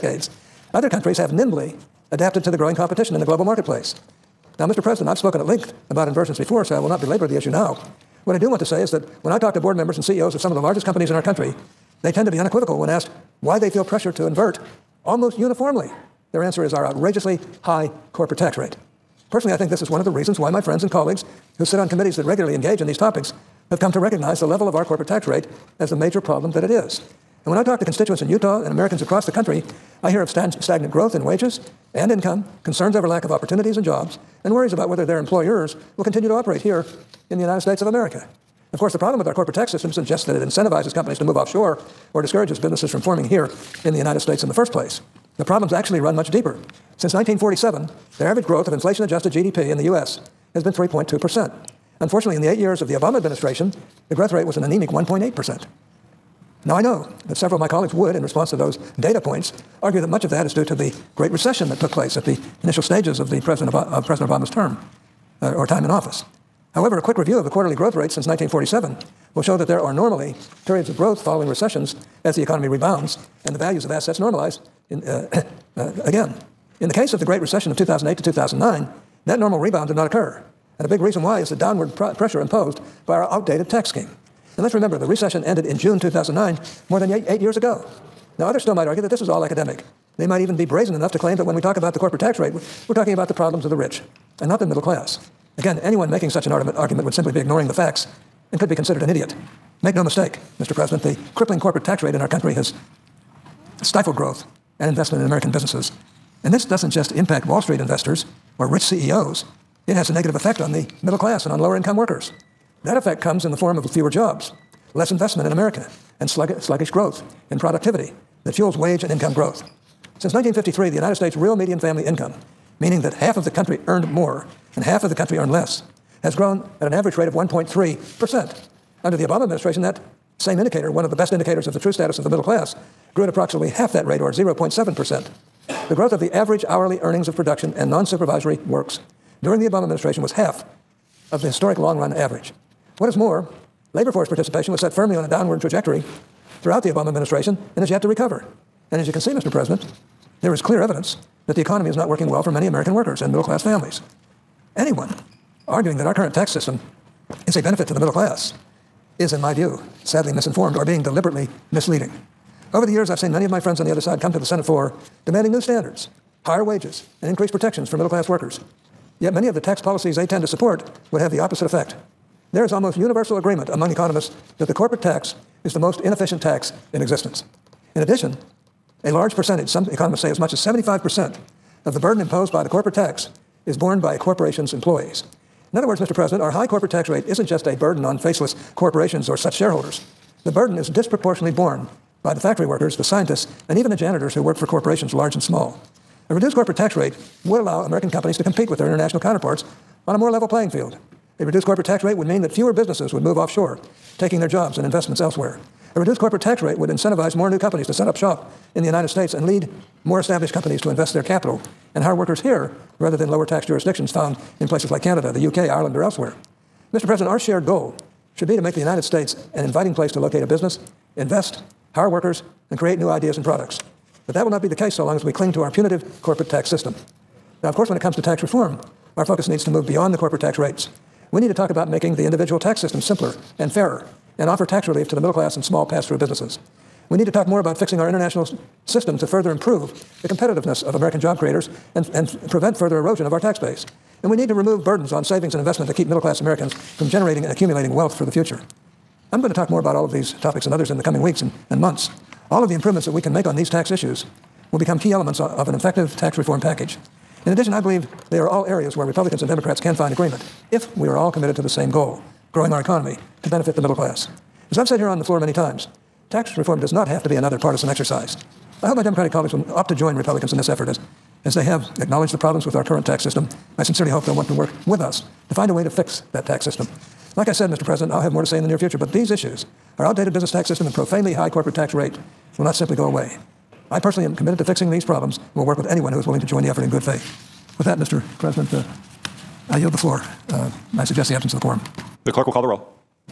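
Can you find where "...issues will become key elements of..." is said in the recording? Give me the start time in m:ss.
4:13.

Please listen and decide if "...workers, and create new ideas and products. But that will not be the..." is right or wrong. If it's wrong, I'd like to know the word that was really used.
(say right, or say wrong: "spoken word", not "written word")
right.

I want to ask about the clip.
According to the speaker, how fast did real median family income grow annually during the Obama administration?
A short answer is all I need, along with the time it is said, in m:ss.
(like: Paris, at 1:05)
0.7%, at 2:14.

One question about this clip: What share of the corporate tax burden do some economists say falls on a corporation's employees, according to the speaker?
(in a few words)
75%.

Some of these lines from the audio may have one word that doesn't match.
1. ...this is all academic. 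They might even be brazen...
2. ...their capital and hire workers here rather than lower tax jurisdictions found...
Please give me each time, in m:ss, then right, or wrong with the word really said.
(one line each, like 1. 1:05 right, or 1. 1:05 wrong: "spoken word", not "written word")
1. 1:29 right
2. 3:31 right.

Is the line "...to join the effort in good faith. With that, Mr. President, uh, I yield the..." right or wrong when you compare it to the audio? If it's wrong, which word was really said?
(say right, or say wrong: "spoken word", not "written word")
right.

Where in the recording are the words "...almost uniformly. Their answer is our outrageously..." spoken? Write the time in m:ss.
0:15.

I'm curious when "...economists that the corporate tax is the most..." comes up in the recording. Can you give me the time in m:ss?
2:53.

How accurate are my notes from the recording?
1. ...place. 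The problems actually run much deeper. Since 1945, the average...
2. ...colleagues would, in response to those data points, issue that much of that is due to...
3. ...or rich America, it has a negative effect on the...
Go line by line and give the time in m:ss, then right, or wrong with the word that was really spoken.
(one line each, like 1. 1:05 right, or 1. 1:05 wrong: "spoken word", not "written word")
1. 0:44 wrong: "1947", not "1945"
2. 0:57 wrong: "argue", not "issue"
3. 1:48 wrong: "CEOs", not "America".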